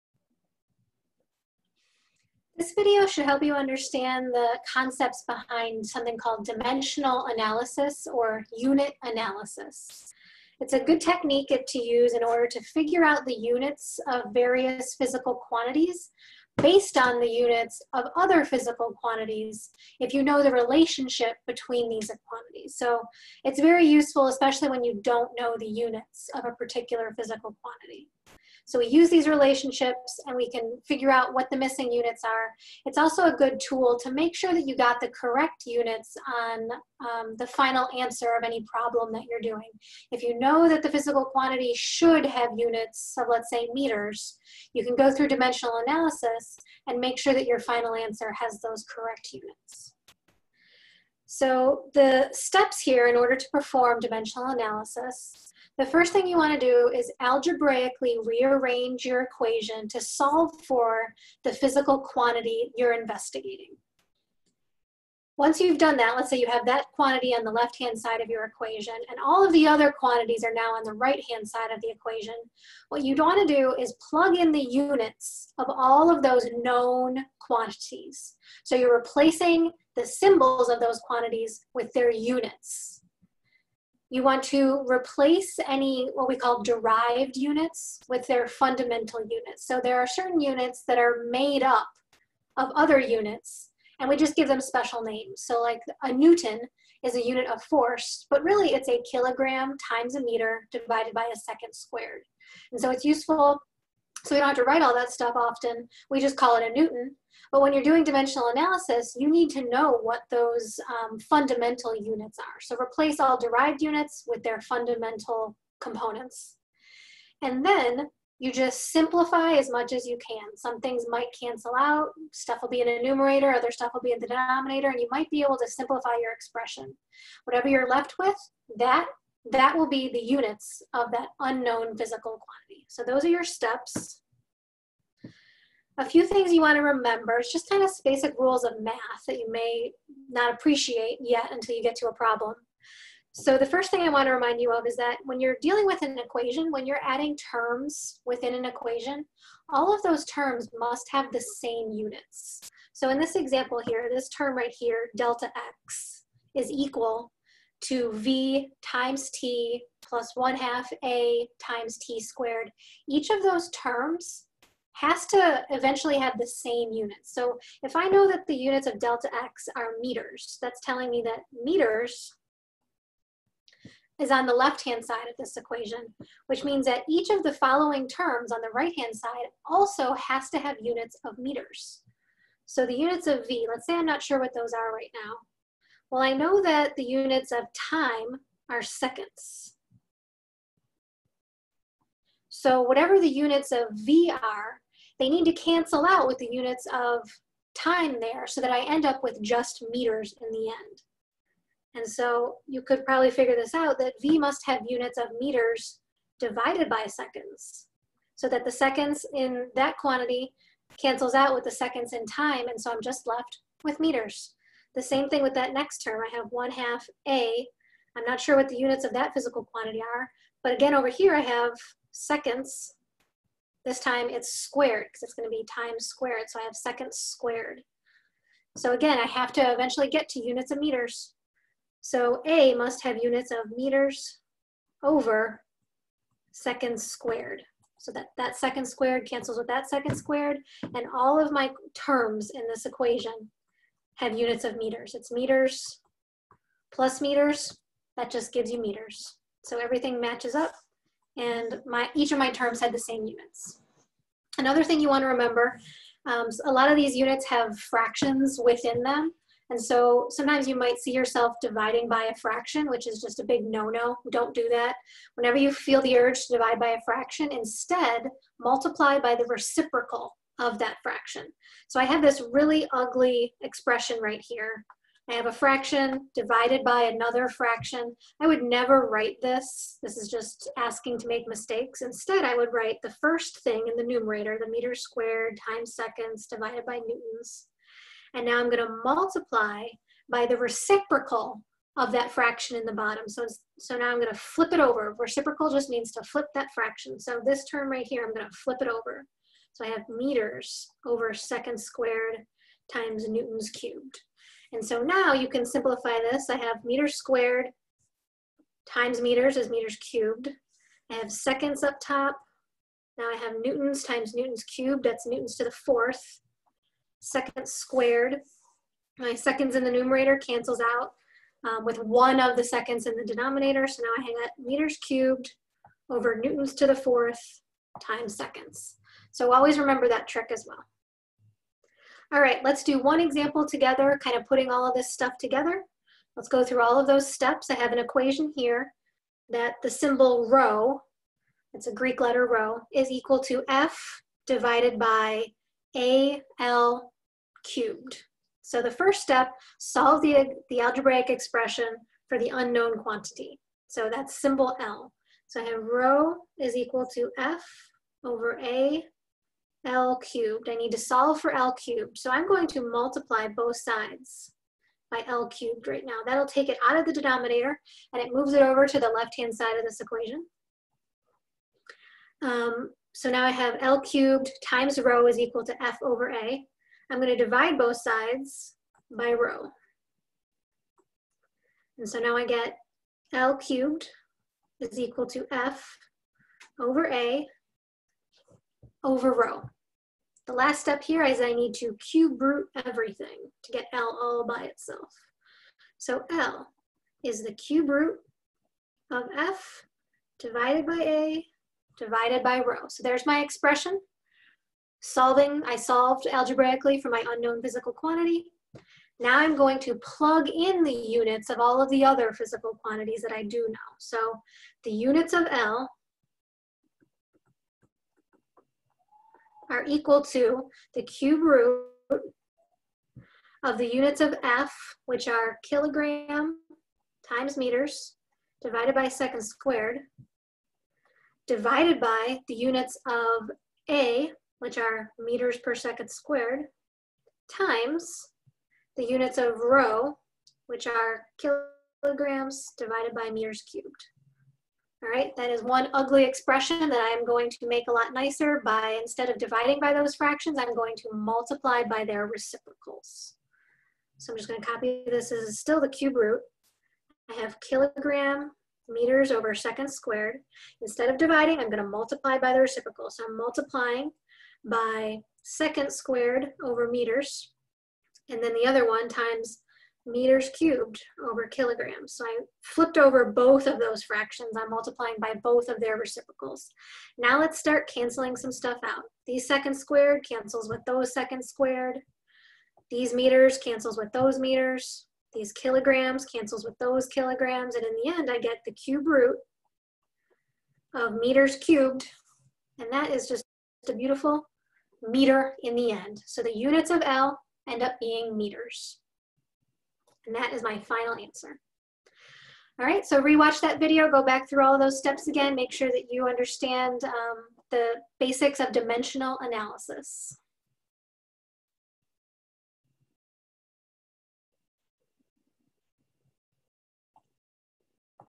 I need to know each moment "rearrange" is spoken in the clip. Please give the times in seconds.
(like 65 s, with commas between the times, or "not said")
58 s.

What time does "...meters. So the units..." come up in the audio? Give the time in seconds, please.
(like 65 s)
181 s.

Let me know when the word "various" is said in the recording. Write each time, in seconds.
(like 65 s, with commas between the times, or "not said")
14 s.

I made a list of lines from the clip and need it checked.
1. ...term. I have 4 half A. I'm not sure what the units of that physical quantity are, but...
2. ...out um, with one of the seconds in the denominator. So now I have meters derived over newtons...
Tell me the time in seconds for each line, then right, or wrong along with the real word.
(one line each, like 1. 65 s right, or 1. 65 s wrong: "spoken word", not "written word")
1. 216 s wrong: "1", not "4"
2. 320 s wrong: "cubed", not "derived".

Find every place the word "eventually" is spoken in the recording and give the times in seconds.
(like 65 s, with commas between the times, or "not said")
165 s, 229 s.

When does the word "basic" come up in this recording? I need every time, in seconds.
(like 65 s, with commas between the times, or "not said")
138 s, 508 s.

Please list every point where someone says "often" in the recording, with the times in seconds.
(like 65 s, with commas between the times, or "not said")
105 s.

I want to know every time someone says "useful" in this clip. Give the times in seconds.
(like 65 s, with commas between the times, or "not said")
23 s, 103 s.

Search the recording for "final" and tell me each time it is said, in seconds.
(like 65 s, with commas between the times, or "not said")
37 s, 47 s, 500 s.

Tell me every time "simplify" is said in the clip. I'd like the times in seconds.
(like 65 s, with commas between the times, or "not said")
118 s, 125 s, 305 s.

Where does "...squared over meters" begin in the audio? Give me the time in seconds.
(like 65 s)
465 s.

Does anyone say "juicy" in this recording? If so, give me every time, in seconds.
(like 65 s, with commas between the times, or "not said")
not said.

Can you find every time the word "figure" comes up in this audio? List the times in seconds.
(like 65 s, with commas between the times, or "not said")
12 s, 30 s, 203 s.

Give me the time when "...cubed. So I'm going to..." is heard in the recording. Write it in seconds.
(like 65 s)
361 s.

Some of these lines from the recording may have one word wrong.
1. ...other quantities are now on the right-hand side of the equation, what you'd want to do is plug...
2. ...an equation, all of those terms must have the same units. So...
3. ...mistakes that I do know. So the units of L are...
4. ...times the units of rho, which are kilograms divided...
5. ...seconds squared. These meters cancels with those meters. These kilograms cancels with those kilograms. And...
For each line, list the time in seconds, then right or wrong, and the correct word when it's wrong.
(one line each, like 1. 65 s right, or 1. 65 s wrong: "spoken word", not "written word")
1. 69 s right
2. 148 s right
3. 412 s wrong: "quantities", not "mistakes"
4. 437 s right
5. 481 s right.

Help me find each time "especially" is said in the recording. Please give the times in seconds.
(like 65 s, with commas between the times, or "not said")
24 s.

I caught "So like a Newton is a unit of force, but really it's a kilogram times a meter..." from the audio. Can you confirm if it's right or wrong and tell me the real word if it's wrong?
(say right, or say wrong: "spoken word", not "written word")
right.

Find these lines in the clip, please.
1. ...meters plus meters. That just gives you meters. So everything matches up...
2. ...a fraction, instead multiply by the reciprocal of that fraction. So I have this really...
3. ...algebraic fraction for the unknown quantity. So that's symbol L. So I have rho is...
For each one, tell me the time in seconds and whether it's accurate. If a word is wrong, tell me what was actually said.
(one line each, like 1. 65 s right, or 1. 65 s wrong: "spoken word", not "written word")
1. 245 s right
2. 266 s right
3. 350 s wrong: "expression", not "fraction".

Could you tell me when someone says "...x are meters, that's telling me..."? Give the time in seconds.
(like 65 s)
169 s.